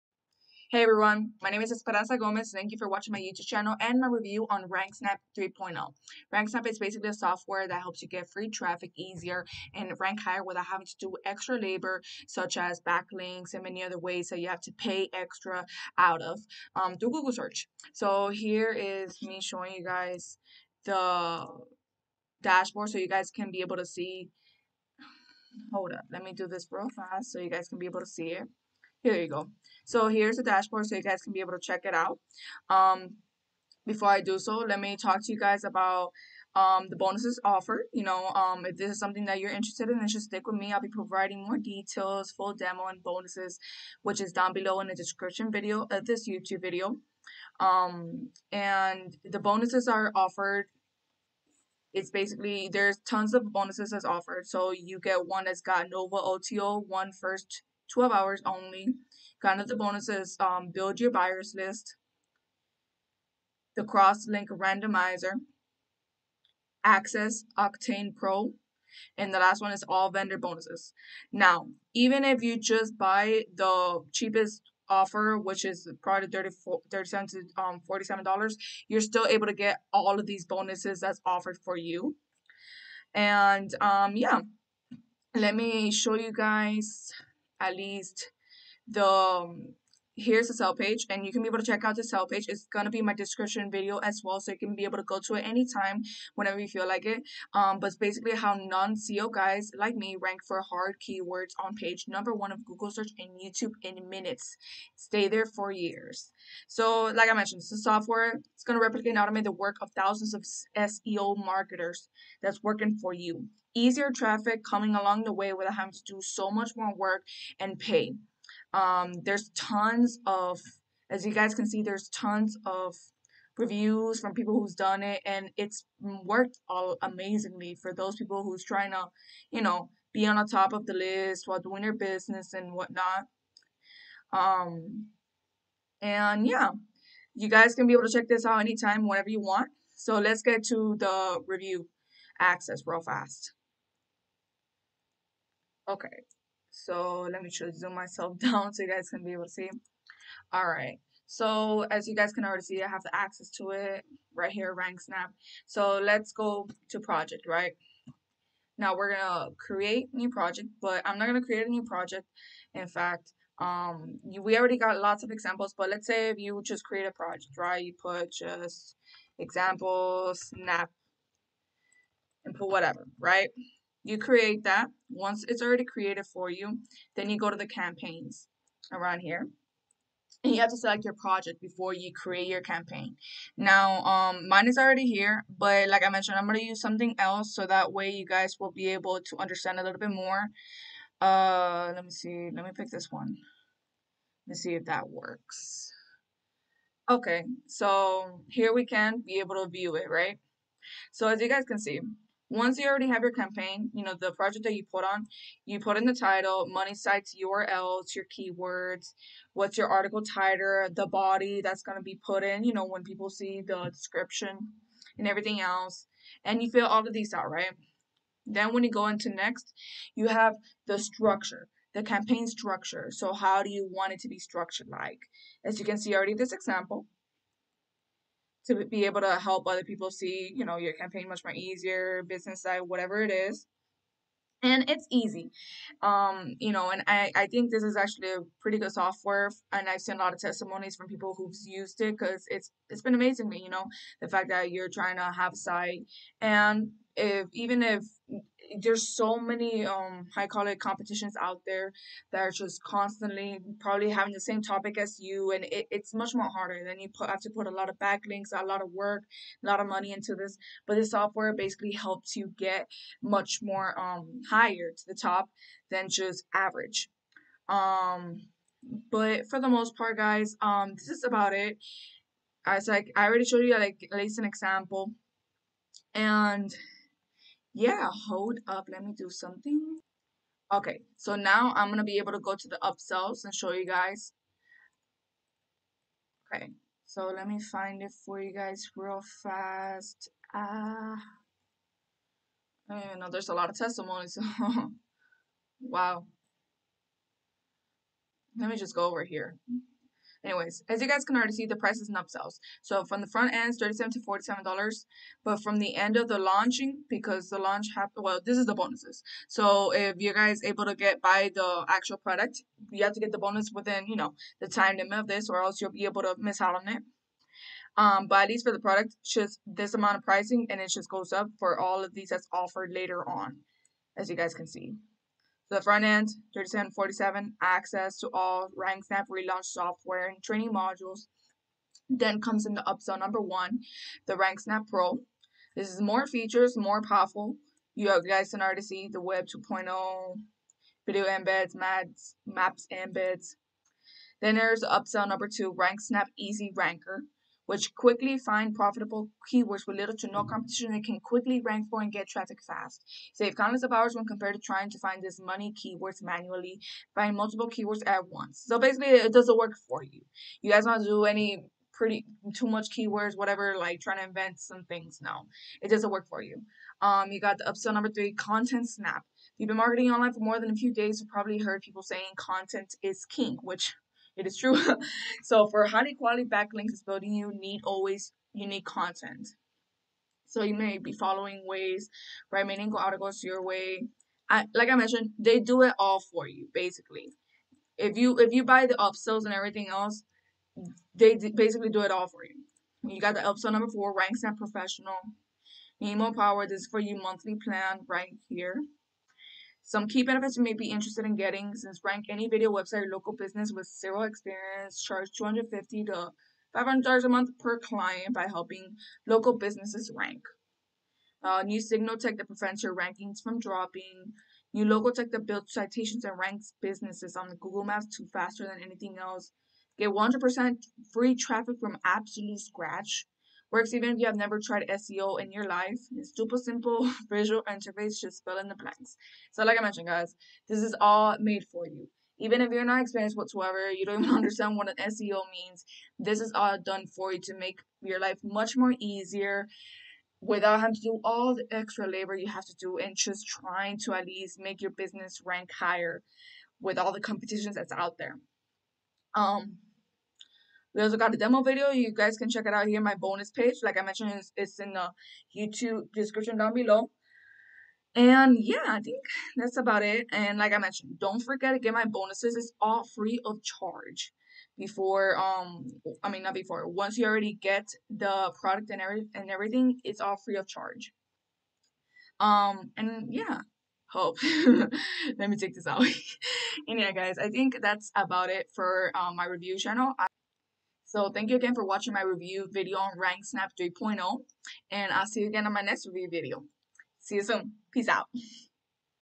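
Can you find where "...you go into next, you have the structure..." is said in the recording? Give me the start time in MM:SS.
03:38.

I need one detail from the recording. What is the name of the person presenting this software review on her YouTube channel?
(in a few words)
Esperanza Gomez.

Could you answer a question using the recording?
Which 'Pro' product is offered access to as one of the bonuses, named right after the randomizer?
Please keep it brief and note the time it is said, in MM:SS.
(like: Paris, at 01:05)
Octane Pro, at 01:07.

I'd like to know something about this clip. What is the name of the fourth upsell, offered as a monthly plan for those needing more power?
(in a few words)
RankSnap professional.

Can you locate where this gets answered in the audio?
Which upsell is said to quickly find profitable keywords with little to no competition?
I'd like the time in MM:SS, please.
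05:45.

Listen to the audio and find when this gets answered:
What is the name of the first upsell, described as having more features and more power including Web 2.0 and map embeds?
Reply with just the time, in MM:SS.
05:34.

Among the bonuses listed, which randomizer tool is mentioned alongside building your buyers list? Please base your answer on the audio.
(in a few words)
cross link randomizer.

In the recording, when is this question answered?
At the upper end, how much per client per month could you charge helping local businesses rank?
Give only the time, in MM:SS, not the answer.
06:46.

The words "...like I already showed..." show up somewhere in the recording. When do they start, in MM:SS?
04:32.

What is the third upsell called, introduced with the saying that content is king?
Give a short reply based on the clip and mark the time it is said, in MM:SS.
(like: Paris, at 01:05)
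content snap, at 06:08.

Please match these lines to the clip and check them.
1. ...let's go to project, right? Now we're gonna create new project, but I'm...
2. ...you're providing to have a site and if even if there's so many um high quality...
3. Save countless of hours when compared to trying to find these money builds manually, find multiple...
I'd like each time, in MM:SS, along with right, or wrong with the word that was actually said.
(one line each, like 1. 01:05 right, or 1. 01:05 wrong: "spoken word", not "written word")
1. 02:36 right
2. 04:04 wrong: "trying", not "providing"
3. 05:53 wrong: "keywords", not "builds".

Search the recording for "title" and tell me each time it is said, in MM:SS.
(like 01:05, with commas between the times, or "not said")
03:26, 03:30.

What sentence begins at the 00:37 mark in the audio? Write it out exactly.
You know, um, if this is something that you're interested in, then just stick with me.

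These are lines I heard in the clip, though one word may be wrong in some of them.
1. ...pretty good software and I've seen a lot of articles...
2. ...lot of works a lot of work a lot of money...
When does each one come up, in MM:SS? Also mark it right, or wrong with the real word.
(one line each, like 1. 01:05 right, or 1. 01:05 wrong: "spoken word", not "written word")
1. 03:58 wrong: "testimonies", not "articles"
2. 04:17 wrong: "backlinks", not "works".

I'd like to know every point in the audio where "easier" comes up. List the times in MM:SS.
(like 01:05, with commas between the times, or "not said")
00:08, 01:53, 03:51, 07:18.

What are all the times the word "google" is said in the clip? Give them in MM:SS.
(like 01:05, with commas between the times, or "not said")
00:17, 01:42, 06:57.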